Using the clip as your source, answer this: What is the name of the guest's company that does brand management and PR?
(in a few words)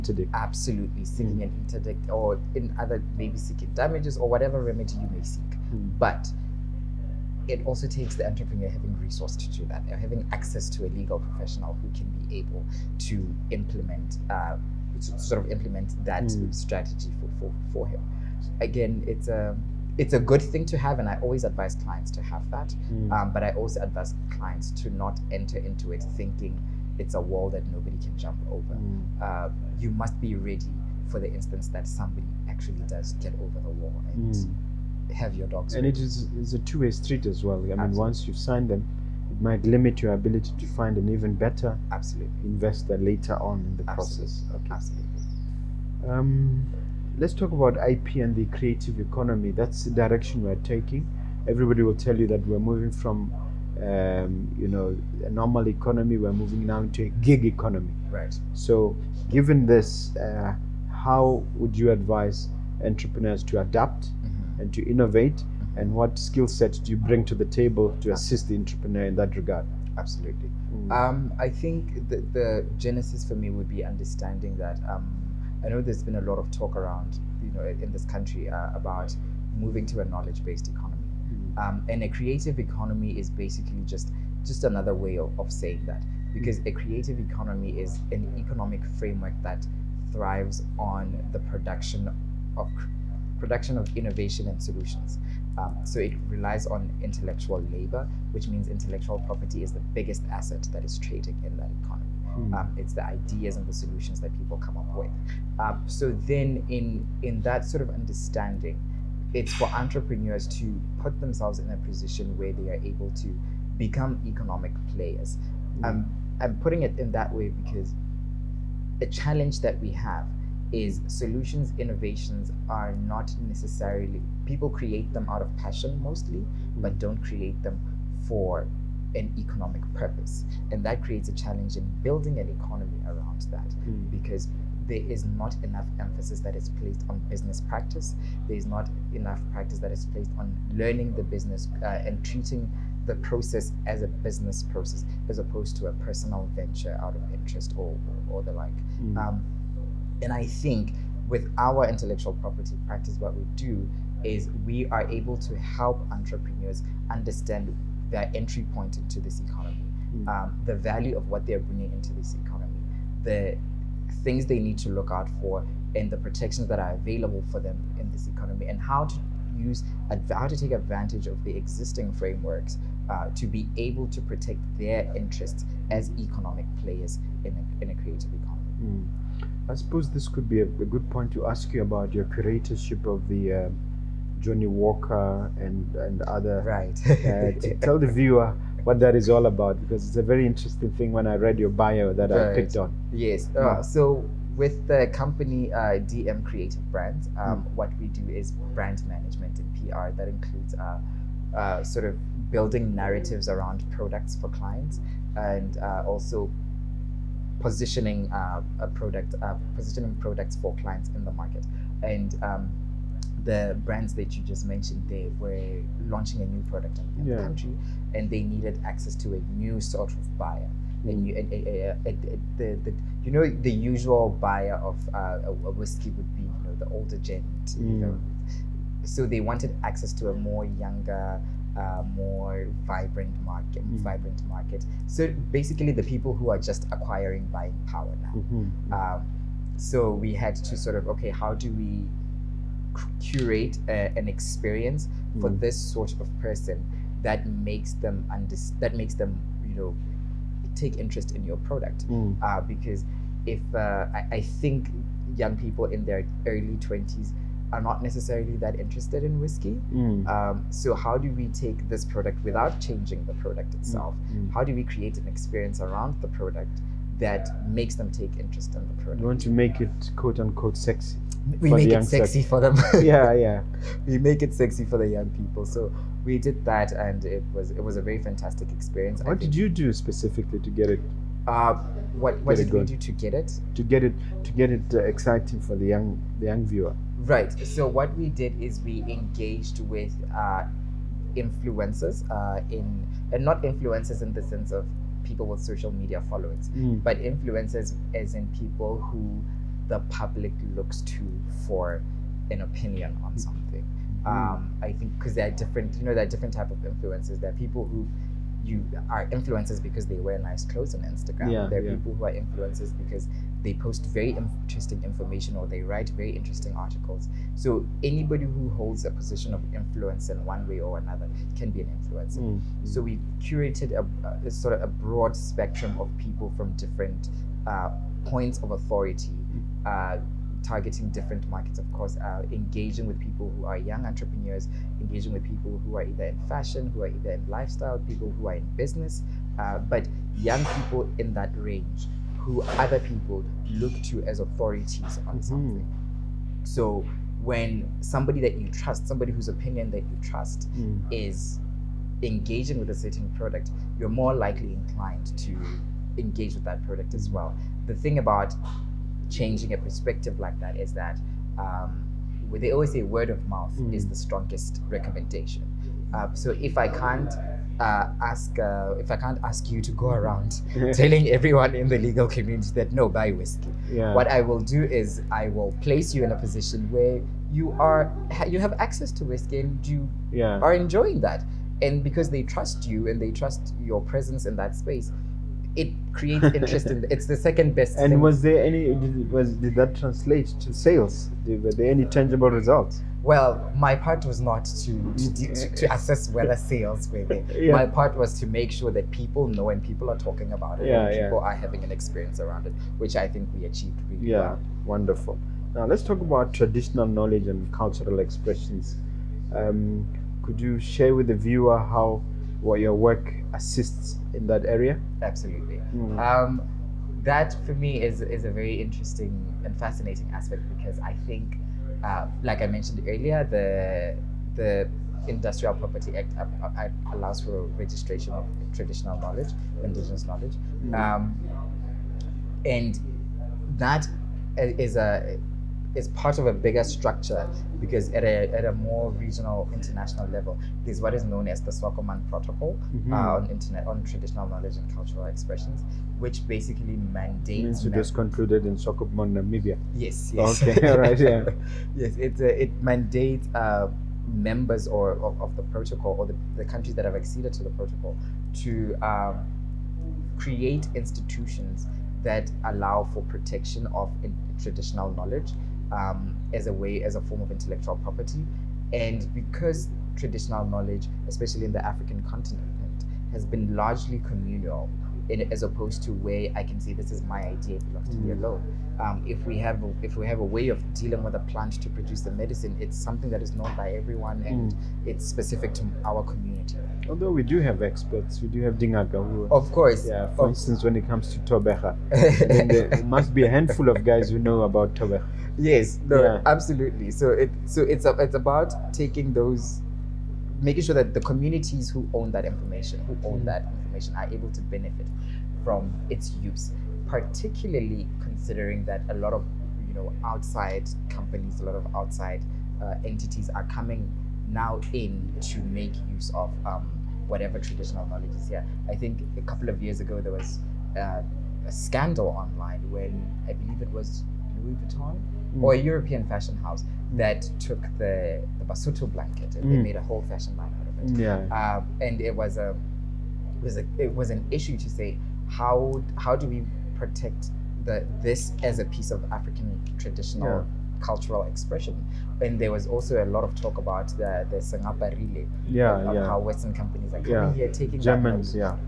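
DM Creative Brands.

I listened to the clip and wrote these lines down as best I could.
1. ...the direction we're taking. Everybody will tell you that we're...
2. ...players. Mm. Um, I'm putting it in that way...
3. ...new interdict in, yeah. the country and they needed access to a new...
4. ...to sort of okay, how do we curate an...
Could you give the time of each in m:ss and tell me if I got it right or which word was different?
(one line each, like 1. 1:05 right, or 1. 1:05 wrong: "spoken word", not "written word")
1. 0:49 right
2. 1:54 right
3. 3:36 wrong: "product", not "interdict"
4. 4:00 right.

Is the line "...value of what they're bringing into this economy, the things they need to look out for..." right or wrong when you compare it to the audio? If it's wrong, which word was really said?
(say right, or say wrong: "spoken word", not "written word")
right.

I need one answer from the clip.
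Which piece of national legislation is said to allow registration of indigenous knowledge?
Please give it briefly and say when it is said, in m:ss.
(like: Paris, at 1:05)
Industrial Property Act, at 7:05.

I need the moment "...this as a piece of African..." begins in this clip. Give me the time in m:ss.
8:58.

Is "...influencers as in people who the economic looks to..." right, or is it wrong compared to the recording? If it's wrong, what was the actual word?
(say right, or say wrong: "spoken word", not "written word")
wrong: "public", not "economic".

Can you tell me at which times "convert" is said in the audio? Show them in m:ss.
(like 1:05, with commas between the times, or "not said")
not said.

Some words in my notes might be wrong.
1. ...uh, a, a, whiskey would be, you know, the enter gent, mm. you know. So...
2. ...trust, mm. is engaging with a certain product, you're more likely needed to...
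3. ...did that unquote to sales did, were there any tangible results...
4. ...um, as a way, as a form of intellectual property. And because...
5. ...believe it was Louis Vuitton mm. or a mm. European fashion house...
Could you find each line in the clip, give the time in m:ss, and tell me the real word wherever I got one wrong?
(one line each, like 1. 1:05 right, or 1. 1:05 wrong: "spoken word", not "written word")
1. 3:45 wrong: "older", not "enter"
2. 5:50 wrong: "inclined", not "needed"
3. 6:29 wrong: "translate", not "unquote"
4. 7:45 right
5. 8:43 right.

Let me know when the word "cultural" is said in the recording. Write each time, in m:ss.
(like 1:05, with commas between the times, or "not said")
6:47, 7:24, 9:00.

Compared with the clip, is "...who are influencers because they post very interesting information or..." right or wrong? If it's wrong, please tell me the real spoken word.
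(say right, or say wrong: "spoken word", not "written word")
right.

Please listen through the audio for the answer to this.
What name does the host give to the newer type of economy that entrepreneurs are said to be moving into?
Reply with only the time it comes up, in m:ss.
0:57.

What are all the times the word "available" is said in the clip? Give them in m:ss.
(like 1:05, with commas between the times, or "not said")
2:46.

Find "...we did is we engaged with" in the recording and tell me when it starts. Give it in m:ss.
4:48.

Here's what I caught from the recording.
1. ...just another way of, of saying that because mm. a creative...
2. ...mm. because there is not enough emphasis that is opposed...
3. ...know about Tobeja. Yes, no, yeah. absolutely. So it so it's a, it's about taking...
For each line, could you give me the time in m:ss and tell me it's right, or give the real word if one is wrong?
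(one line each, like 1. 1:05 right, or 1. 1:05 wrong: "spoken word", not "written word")
1. 1:24 right
2. 2:13 wrong: "placed", not "opposed"
3. 8:14 right.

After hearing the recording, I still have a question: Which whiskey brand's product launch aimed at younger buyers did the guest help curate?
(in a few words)
Johnnie Walker.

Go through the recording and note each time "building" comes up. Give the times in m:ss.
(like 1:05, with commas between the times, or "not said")
2:12, 3:22.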